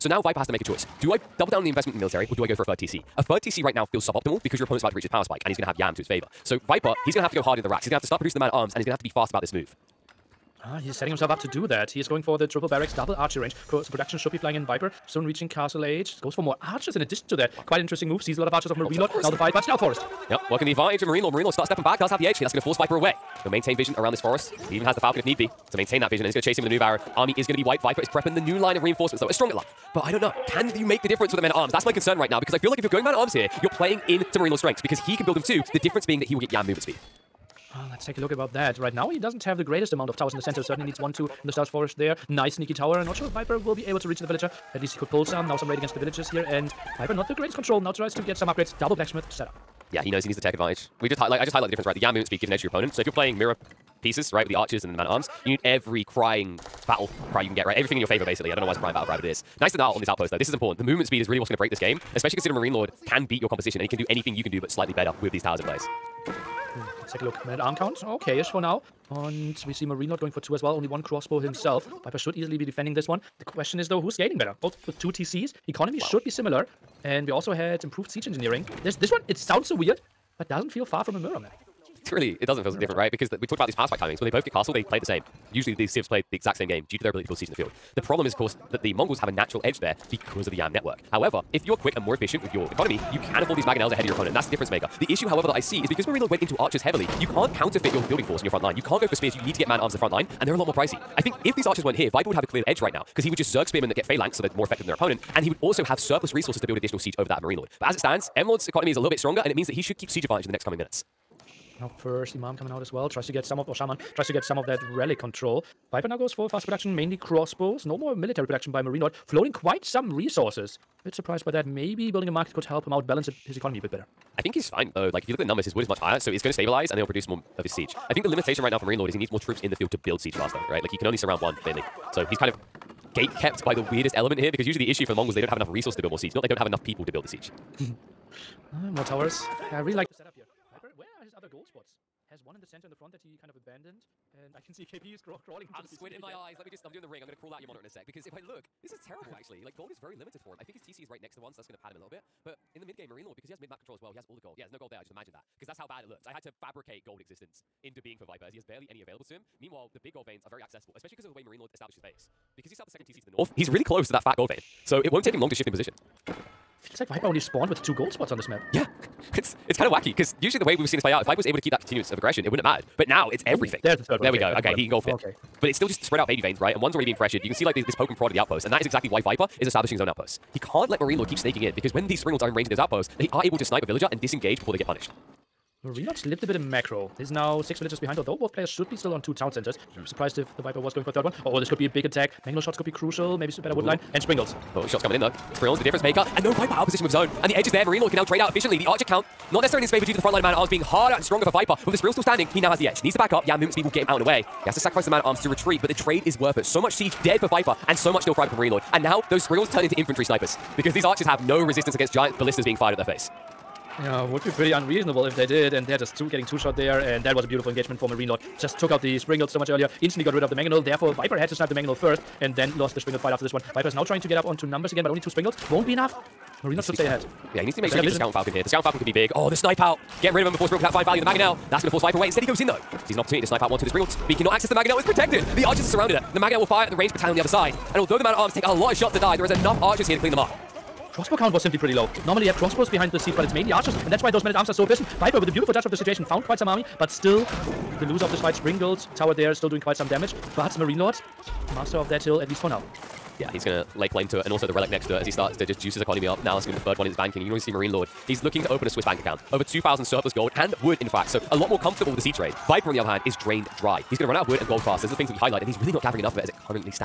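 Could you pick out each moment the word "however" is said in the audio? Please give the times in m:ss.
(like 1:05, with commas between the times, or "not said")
1:31, 1:35.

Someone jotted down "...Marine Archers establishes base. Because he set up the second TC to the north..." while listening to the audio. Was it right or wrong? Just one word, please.
wrong.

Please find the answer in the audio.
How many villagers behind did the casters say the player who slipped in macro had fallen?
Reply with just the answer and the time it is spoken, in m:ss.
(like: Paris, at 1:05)
6, at 3:07.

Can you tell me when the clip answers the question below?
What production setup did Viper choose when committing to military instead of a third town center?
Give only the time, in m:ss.
0:12.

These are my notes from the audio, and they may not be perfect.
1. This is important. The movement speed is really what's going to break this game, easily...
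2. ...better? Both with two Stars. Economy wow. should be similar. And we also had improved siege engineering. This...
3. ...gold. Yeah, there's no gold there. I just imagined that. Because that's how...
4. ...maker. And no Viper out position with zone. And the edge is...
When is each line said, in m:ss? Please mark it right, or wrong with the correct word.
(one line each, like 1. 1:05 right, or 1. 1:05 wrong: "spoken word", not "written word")
1. 1:00 wrong: "especially", not "easily"
2. 1:14 wrong: "TCs", not "Stars"
3. 2:34 right
4. 3:16 right.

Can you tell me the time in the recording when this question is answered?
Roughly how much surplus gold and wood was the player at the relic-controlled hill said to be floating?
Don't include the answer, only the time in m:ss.
4:19.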